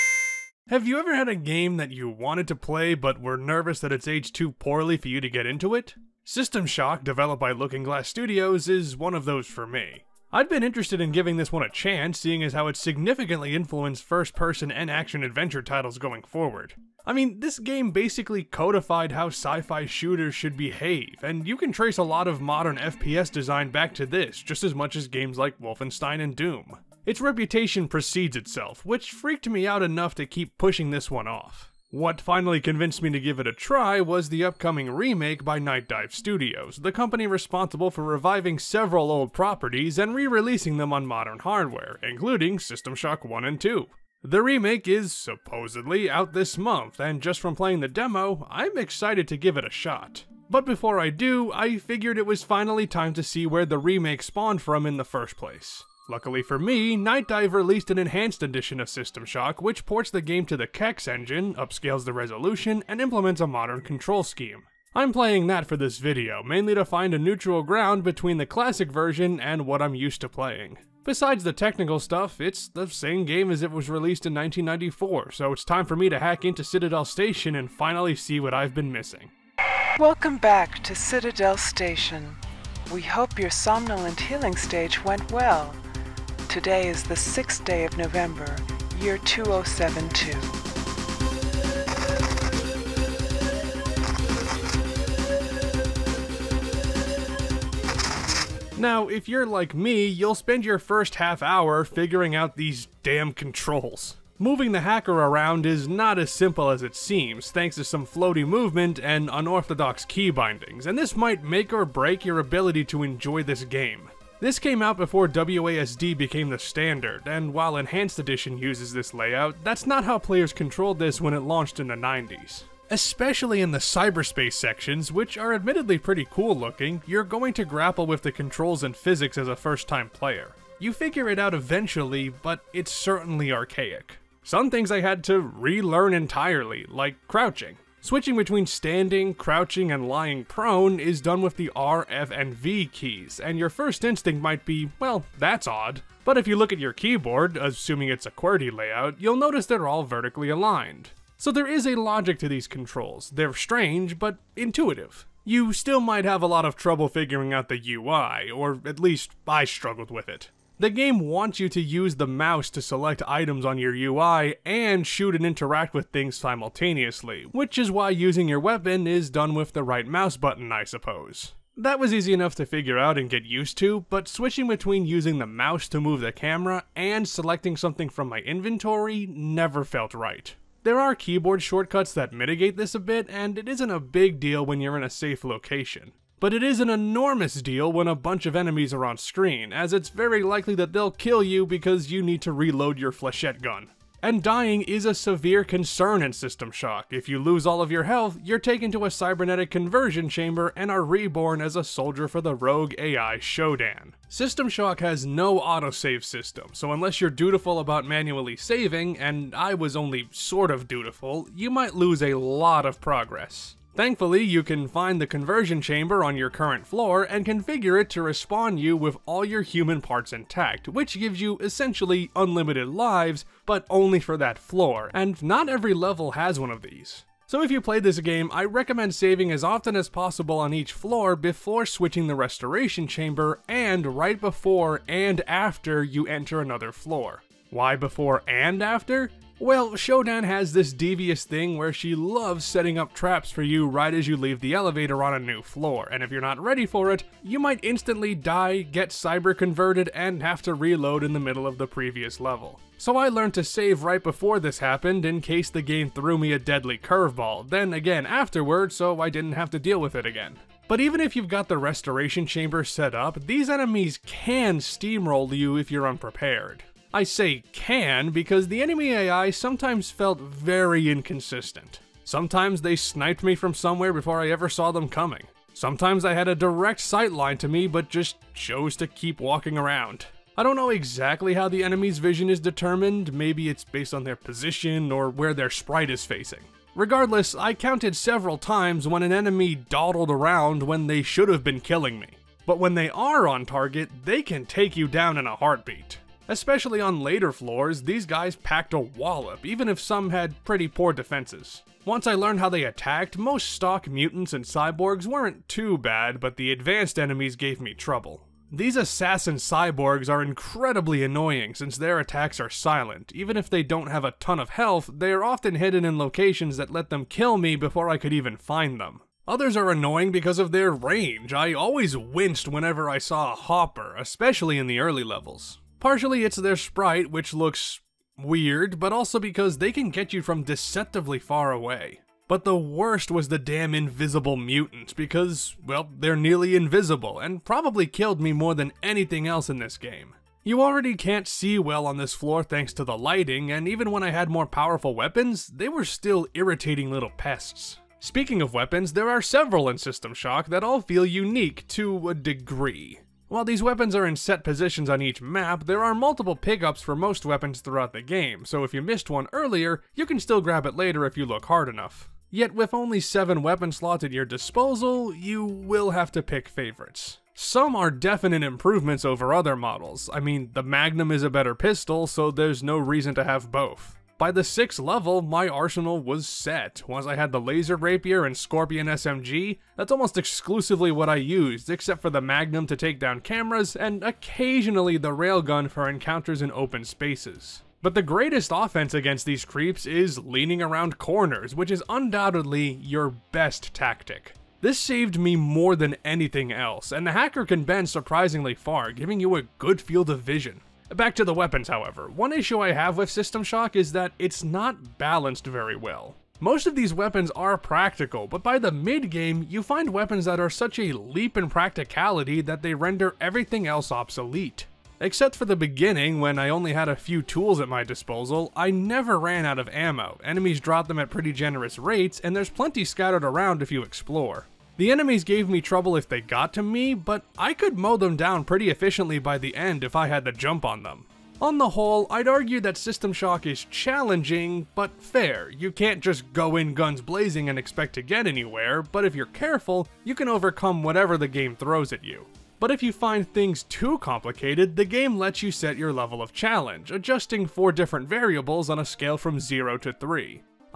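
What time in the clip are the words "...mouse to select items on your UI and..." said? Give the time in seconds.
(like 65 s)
162 s.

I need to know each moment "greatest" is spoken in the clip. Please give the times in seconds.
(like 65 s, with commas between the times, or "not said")
388 s.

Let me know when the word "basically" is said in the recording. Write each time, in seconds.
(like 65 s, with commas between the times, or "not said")
17 s.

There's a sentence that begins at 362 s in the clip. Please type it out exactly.
Yet with only 7 weapon slots at your disposal, you will have to pick favorites.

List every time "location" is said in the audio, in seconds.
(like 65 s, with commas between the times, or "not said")
185 s, 316 s.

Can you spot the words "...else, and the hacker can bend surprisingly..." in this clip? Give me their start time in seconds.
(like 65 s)
396 s.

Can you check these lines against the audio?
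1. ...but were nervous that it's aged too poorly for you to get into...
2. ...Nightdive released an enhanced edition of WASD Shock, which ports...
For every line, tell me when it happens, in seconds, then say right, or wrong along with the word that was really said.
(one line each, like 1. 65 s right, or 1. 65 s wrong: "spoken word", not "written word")
1. 2 s right
2. 56 s wrong: "System", not "WASD".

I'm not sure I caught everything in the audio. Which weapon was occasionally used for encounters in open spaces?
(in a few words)
Railgun.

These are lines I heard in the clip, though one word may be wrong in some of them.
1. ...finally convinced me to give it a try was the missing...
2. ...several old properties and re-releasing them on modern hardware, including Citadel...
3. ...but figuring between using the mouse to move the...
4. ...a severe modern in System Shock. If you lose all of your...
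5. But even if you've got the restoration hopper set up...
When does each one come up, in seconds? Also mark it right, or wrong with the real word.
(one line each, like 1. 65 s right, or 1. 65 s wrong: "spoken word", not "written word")
1. 32 s wrong: "upcoming", not "missing"
2. 38 s wrong: "System", not "Citadel"
3. 174 s wrong: "switching", not "figuring"
4. 195 s wrong: "concern", not "modern"
5. 260 s wrong: "chamber", not "hopper".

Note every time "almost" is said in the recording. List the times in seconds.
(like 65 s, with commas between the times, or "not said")
380 s.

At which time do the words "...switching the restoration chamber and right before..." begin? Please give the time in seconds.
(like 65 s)
231 s.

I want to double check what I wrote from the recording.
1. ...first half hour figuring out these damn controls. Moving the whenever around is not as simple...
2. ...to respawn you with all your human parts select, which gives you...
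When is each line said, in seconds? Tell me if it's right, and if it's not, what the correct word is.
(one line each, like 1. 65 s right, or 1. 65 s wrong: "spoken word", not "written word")
1. 100 s wrong: "hacker", not "whenever"
2. 218 s wrong: "intact", not "select".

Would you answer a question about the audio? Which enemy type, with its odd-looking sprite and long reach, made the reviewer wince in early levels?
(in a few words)
hopper.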